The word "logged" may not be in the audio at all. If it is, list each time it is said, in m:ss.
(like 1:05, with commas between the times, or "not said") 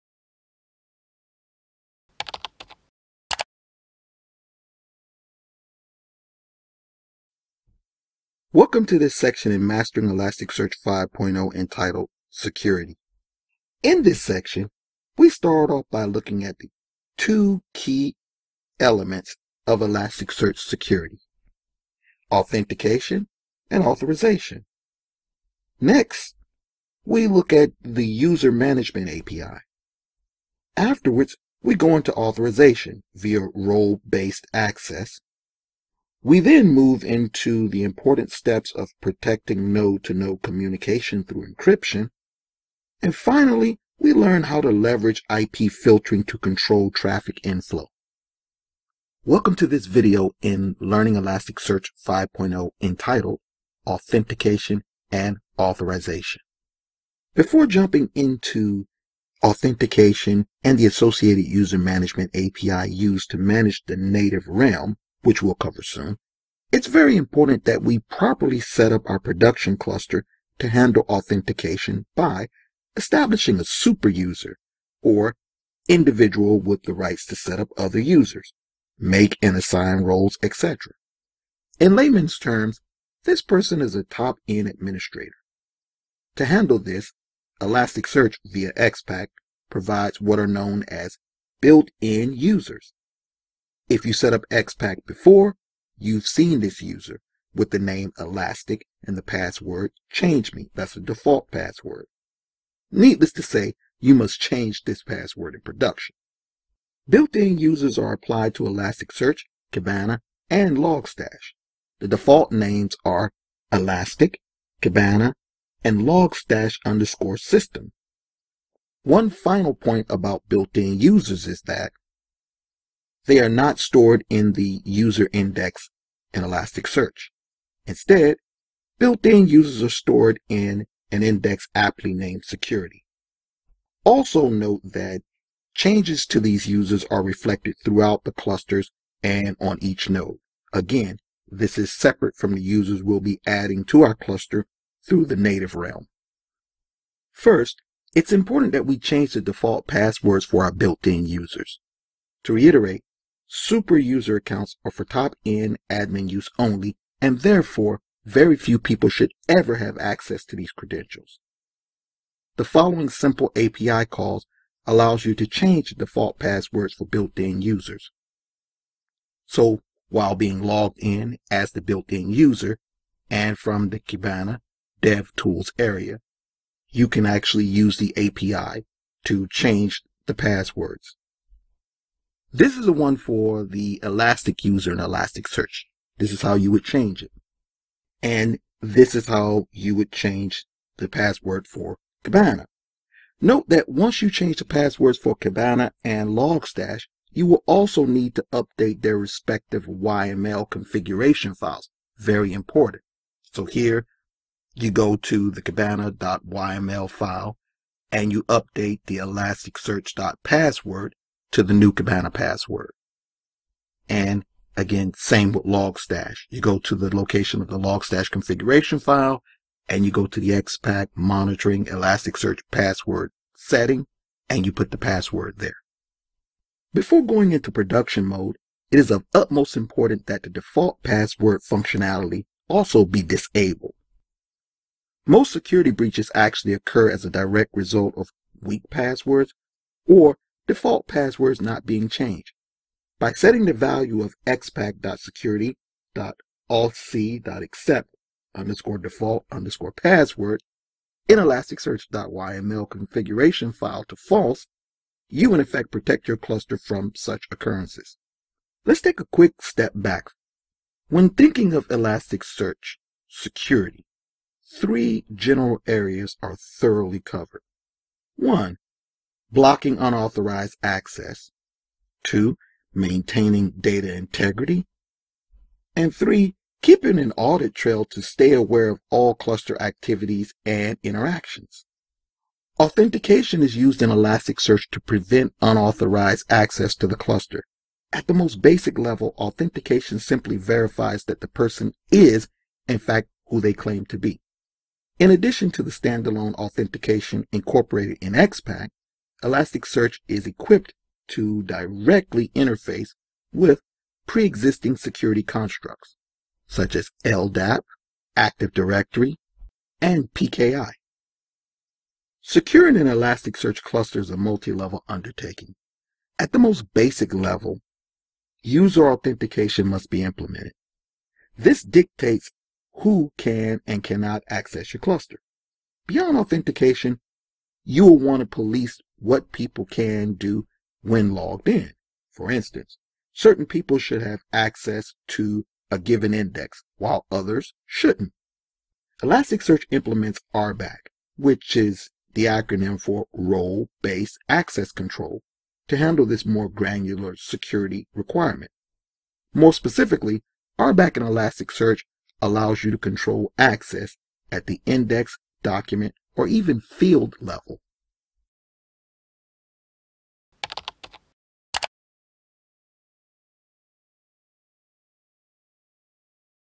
2:50, 5:31.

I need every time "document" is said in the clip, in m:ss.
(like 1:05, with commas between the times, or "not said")
5:55.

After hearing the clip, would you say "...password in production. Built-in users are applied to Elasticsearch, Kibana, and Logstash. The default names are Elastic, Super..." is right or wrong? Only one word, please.
wrong.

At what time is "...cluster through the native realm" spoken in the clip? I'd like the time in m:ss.
2:24.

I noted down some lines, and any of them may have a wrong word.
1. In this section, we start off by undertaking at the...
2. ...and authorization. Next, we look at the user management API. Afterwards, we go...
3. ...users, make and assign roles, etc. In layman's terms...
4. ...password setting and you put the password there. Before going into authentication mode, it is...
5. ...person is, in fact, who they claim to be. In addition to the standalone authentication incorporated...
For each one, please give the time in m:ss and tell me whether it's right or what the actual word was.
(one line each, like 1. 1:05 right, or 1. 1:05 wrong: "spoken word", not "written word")
1. 0:13 wrong: "looking", not "undertaking"
2. 0:23 right
3. 1:17 right
4. 3:42 wrong: "production", not "authentication"
5. 4:51 right.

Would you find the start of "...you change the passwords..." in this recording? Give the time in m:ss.
3:14.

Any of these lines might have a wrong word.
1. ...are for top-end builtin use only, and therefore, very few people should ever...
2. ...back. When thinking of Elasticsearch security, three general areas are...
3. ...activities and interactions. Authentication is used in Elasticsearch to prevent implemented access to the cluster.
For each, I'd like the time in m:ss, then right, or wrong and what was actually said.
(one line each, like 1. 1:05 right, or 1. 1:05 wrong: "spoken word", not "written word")
1. 2:34 wrong: "admin", not "builtin"
2. 4:19 right
3. 4:39 wrong: "unauthorized", not "implemented".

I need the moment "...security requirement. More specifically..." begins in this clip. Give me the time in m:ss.
5:47.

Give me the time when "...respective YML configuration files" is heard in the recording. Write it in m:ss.
3:19.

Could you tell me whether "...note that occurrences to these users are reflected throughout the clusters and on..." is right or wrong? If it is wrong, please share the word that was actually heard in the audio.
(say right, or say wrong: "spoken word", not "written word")
wrong: "changes", not "occurrences".